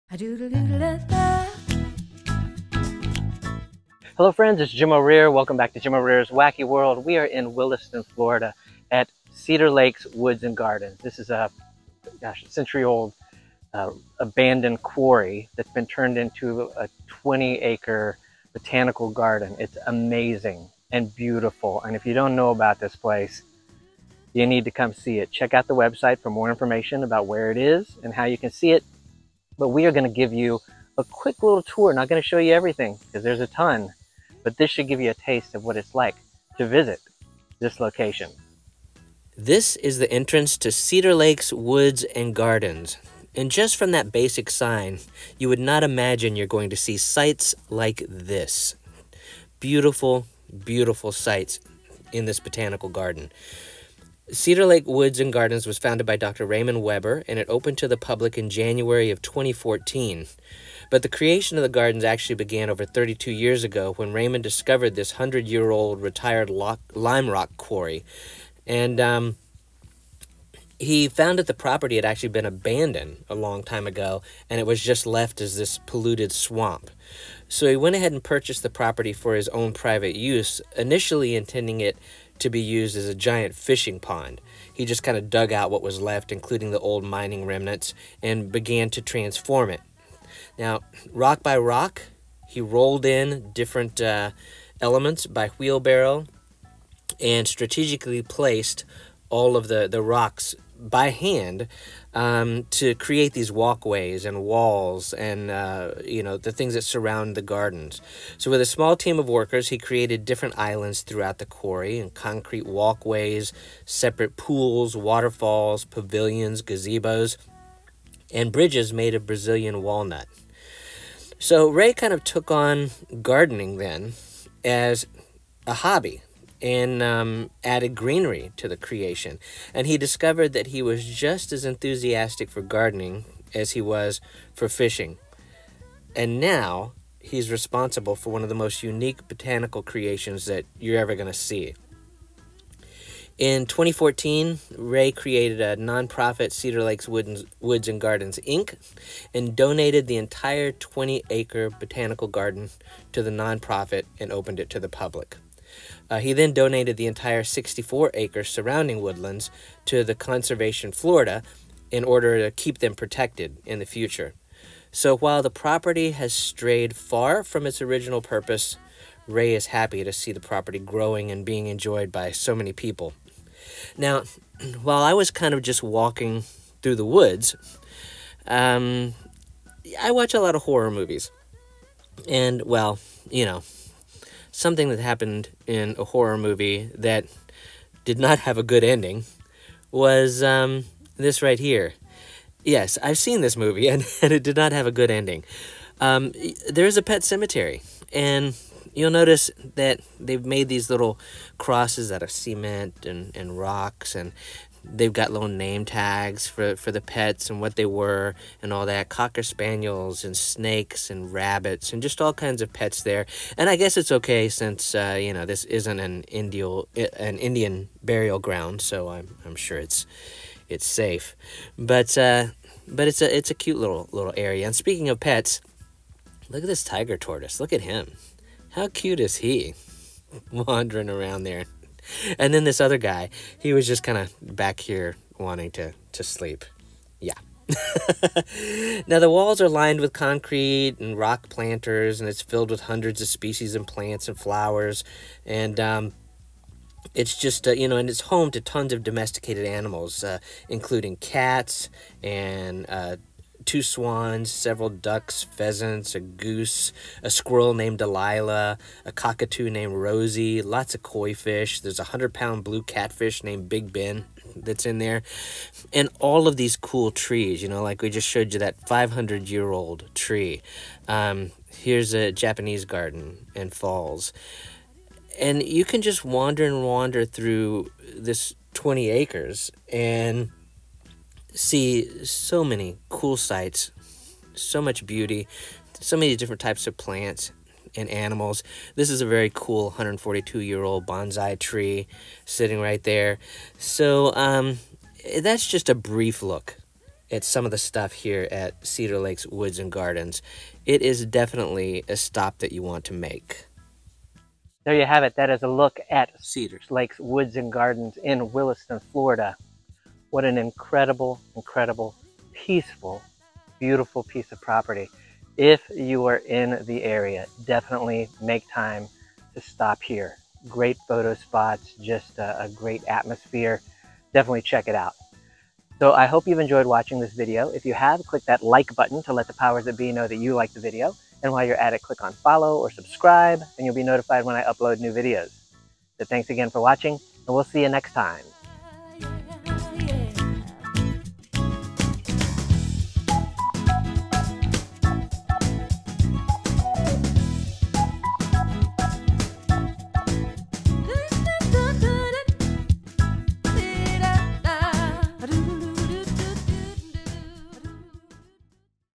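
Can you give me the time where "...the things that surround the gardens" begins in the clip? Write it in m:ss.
1:46.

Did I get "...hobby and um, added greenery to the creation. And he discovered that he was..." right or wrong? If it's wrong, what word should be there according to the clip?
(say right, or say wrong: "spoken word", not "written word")
right.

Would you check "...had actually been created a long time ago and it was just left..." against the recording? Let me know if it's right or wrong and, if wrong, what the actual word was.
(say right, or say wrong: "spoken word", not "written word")
wrong: "abandoned", not "created".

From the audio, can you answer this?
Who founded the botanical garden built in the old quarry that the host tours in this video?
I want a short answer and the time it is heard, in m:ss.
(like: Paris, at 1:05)
Dr. Raymond Weber, at 0:56.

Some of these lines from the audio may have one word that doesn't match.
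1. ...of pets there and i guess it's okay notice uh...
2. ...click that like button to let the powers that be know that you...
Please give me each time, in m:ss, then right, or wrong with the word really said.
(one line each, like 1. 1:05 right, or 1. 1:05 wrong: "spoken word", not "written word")
1. 3:32 wrong: "since", not "notice"
2. 5:28 right.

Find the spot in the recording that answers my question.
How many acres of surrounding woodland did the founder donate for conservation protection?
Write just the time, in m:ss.
2:37.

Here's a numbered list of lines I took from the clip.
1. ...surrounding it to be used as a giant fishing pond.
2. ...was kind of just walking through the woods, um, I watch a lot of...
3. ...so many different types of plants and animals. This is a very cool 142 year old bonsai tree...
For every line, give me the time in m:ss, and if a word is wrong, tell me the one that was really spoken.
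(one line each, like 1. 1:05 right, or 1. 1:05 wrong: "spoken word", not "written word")
1. 1:21 wrong: "intending", not "surrounding"
2. 2:55 right
3. 4:45 right.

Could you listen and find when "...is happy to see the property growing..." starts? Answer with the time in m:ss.
2:49.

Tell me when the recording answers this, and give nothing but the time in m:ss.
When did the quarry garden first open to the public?
0:58.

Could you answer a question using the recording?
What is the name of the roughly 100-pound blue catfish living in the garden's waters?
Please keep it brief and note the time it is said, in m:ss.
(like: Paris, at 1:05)
Big Ben, at 4:23.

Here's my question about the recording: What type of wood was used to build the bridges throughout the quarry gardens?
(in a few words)
Brazilian walnut.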